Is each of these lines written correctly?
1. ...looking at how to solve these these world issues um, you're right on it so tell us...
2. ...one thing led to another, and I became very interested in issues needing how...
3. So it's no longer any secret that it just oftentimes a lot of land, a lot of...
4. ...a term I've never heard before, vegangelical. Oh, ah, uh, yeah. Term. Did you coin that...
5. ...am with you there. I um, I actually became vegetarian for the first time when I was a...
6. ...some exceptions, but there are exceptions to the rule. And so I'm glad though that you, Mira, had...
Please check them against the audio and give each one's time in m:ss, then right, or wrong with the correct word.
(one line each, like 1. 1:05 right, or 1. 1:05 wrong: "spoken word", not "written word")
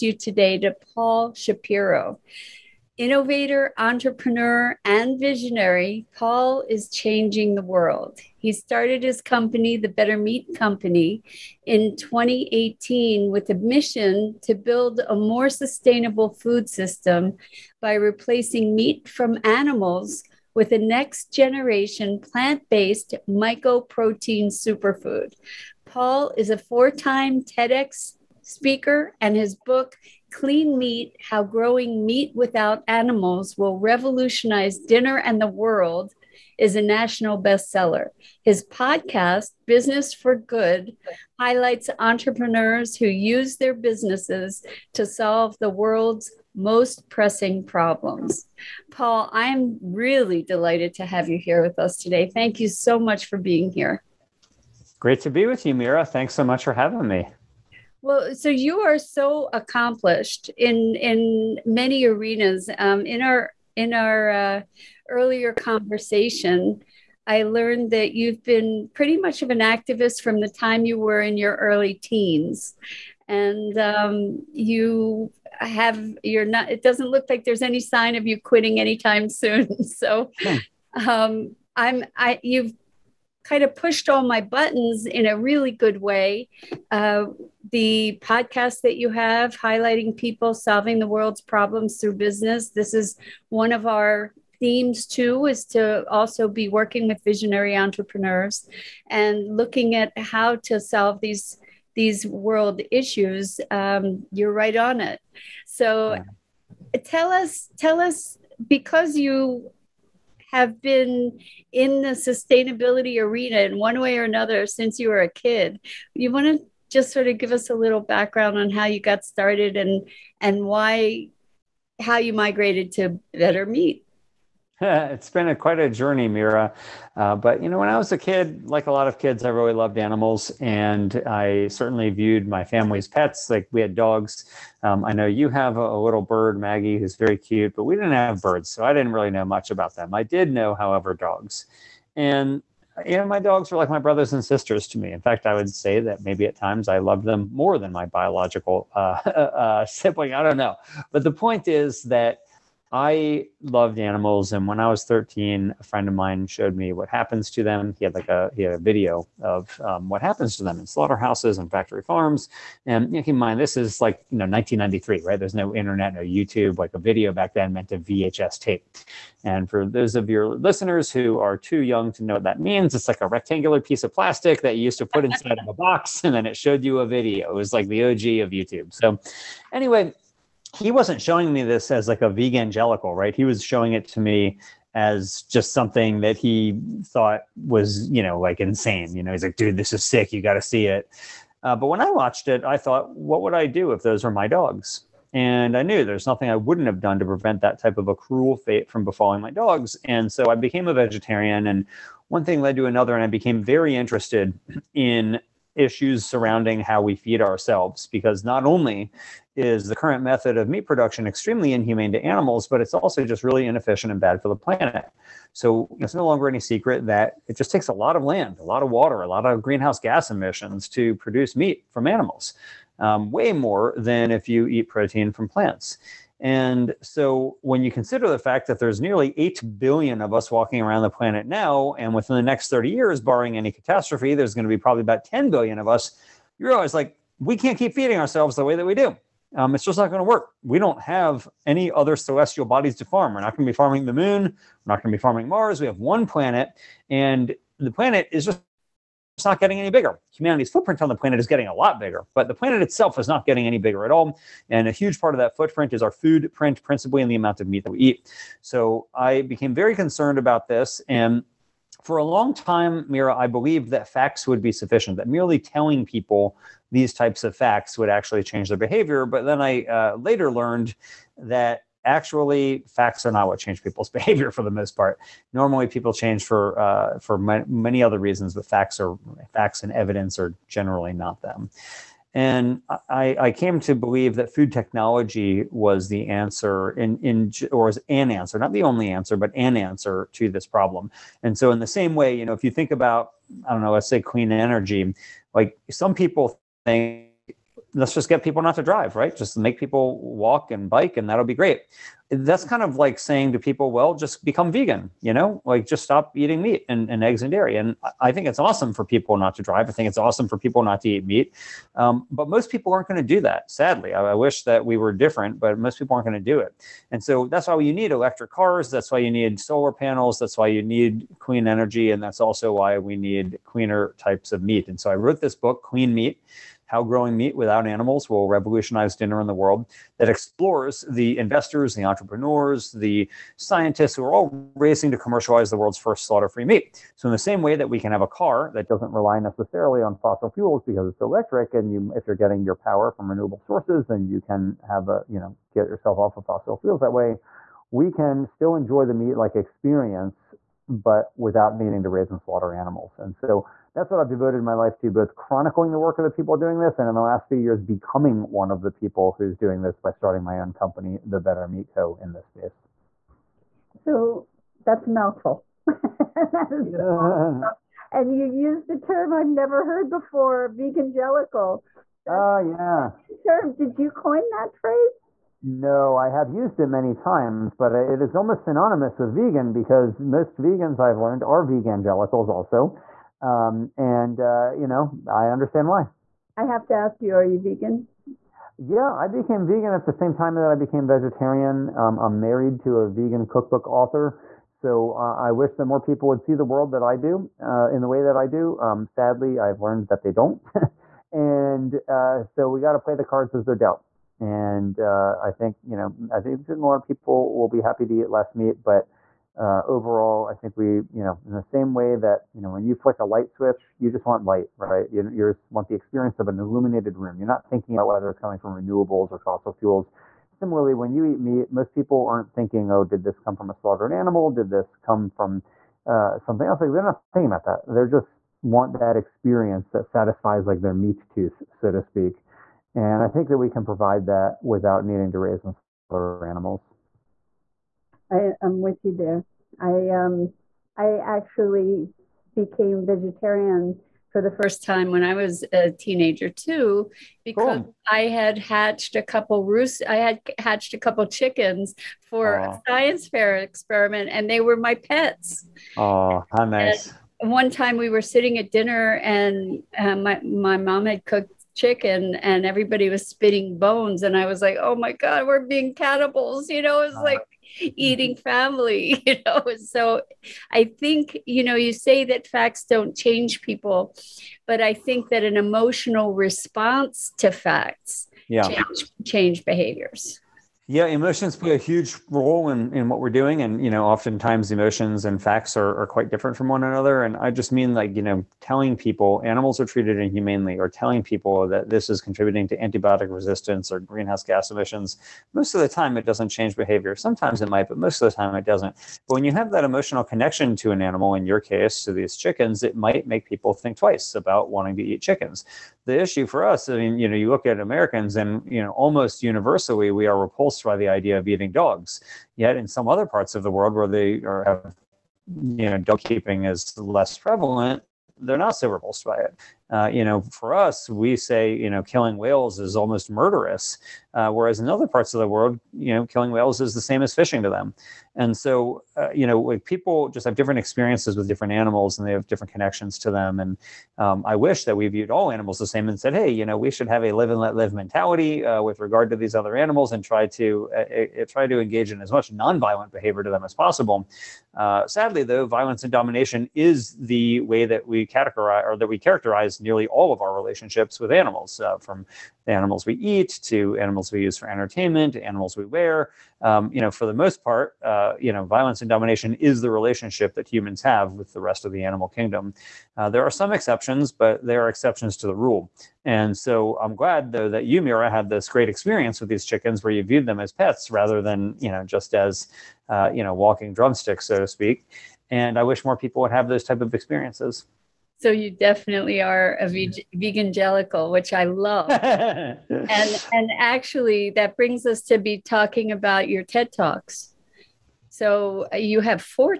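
1. 1:39 right
2. 3:22 wrong: "surrounding", not "needing"
3. 3:35 wrong: "takes", not "oftentimes"
4. 6:08 right
5. 7:18 right
6. 9:23 right.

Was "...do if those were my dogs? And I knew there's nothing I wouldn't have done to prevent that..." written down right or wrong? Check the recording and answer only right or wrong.
right.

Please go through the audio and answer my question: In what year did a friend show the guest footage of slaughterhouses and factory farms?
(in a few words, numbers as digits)
1993.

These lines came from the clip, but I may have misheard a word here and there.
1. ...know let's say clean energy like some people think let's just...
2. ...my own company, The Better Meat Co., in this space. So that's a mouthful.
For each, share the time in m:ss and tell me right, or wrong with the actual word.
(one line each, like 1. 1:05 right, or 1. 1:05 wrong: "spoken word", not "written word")
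1. 4:53 right
2. 6:00 right.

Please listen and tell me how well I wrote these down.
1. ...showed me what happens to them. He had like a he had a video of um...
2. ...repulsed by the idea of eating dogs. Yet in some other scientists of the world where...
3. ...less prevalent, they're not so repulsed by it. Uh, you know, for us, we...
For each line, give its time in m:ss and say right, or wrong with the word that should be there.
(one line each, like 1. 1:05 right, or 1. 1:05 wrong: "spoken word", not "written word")
1. 2:36 right
2. 8:30 wrong: "parts", not "scientists"
3. 8:36 right.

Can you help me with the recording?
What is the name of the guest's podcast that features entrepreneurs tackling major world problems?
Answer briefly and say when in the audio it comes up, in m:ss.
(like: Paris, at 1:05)
Business for Good, at 0:39.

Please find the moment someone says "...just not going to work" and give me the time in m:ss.
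3:59.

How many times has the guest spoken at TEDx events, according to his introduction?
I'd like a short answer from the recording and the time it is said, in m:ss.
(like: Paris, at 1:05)
4, at 0:26.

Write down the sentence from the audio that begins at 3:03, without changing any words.
He was showing it to me as just something that he thought was, you know, like insane.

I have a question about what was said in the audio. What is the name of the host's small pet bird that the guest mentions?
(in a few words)
Maggie.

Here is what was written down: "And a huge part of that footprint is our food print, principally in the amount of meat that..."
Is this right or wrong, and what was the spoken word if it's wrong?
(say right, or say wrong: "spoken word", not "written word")
right.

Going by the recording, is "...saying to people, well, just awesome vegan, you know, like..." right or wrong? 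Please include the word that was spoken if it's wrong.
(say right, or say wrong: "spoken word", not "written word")
wrong: "become", not "awesome".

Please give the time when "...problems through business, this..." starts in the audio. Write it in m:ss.
1:31.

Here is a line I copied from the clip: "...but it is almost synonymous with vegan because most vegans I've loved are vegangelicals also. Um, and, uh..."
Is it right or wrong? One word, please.
wrong.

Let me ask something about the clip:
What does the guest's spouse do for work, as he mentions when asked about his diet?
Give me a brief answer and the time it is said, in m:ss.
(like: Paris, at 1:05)
vegan cookbook author, at 6:33.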